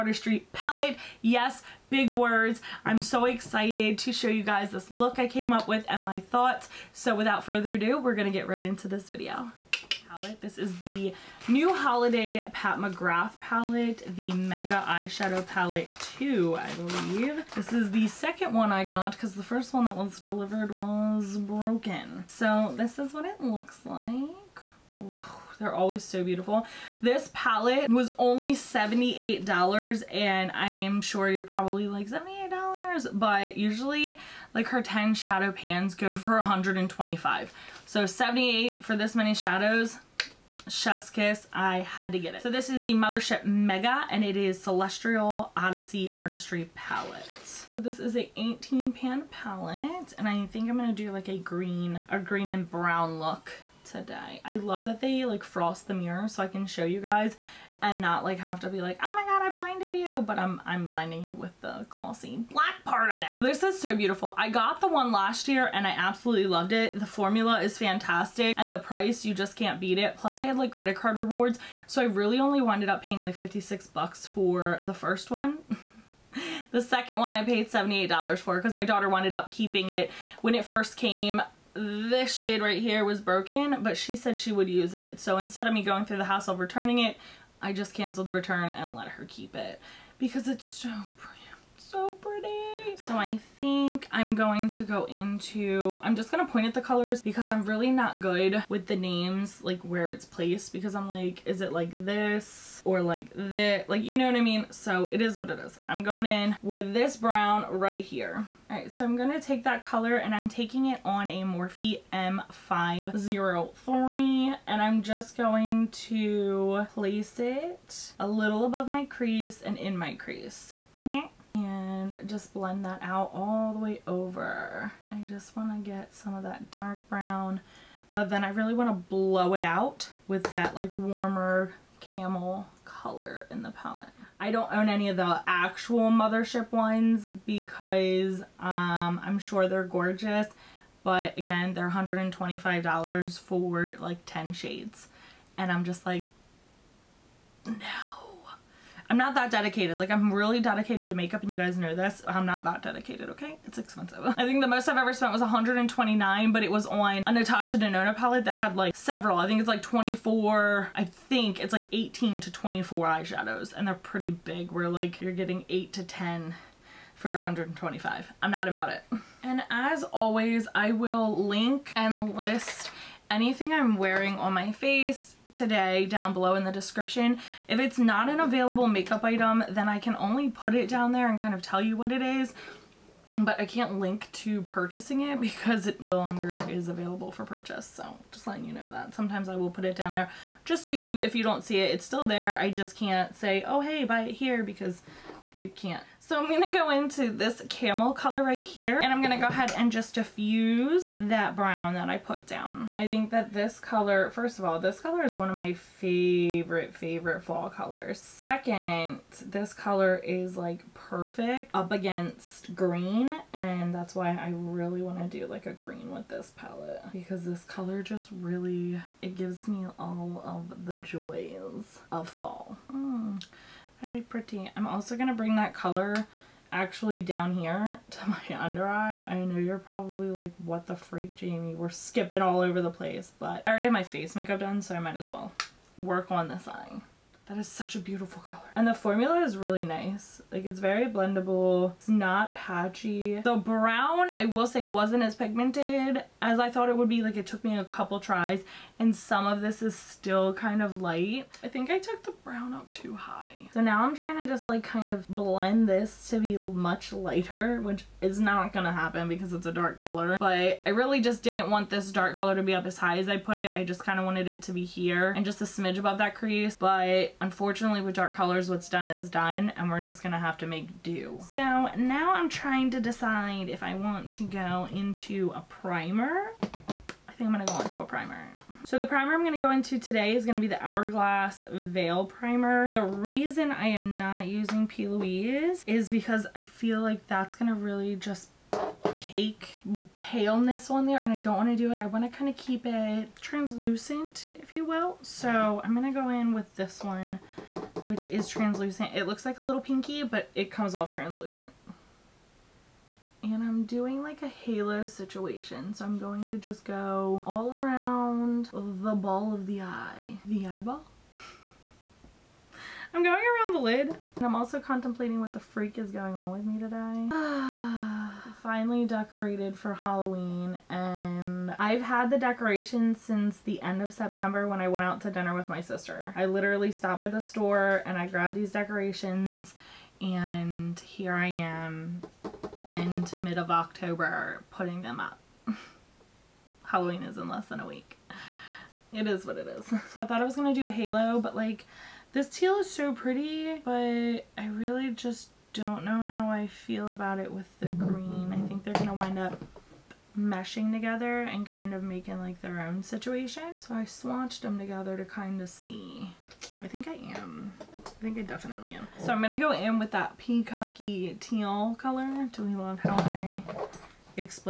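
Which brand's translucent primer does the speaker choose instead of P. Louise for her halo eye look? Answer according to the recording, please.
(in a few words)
Hourglass Veil Primer.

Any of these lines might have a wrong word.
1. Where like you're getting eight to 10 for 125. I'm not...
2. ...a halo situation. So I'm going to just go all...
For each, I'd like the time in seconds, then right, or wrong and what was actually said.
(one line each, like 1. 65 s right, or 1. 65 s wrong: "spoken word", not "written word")
1. 164 s right
2. 304 s right.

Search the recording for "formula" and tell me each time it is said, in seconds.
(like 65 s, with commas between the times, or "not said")
67 s, 238 s.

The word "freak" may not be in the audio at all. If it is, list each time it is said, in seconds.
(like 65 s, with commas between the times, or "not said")
230 s, 315 s.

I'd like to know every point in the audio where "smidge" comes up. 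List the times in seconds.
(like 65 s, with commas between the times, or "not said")
265 s.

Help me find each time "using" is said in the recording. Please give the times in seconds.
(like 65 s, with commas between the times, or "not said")
284 s.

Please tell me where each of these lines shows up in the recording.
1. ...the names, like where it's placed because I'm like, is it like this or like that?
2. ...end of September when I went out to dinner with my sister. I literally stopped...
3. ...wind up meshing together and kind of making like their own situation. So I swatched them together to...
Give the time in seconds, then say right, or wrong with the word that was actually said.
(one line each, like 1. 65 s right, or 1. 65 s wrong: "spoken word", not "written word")
1. 98 s right
2. 323 s right
3. 349 s right.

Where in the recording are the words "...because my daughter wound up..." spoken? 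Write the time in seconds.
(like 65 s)
78 s.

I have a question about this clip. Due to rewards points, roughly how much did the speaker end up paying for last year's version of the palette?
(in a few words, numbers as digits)
$56.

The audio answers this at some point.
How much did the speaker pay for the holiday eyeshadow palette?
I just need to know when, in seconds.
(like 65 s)
27 s.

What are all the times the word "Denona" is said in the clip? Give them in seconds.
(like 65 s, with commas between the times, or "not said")
157 s.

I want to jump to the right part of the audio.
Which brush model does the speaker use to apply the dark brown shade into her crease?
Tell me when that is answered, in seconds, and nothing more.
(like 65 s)
111 s.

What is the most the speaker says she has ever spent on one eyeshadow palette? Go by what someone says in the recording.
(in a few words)
129.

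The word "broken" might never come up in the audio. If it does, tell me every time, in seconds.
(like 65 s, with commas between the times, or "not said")
21 s, 83 s.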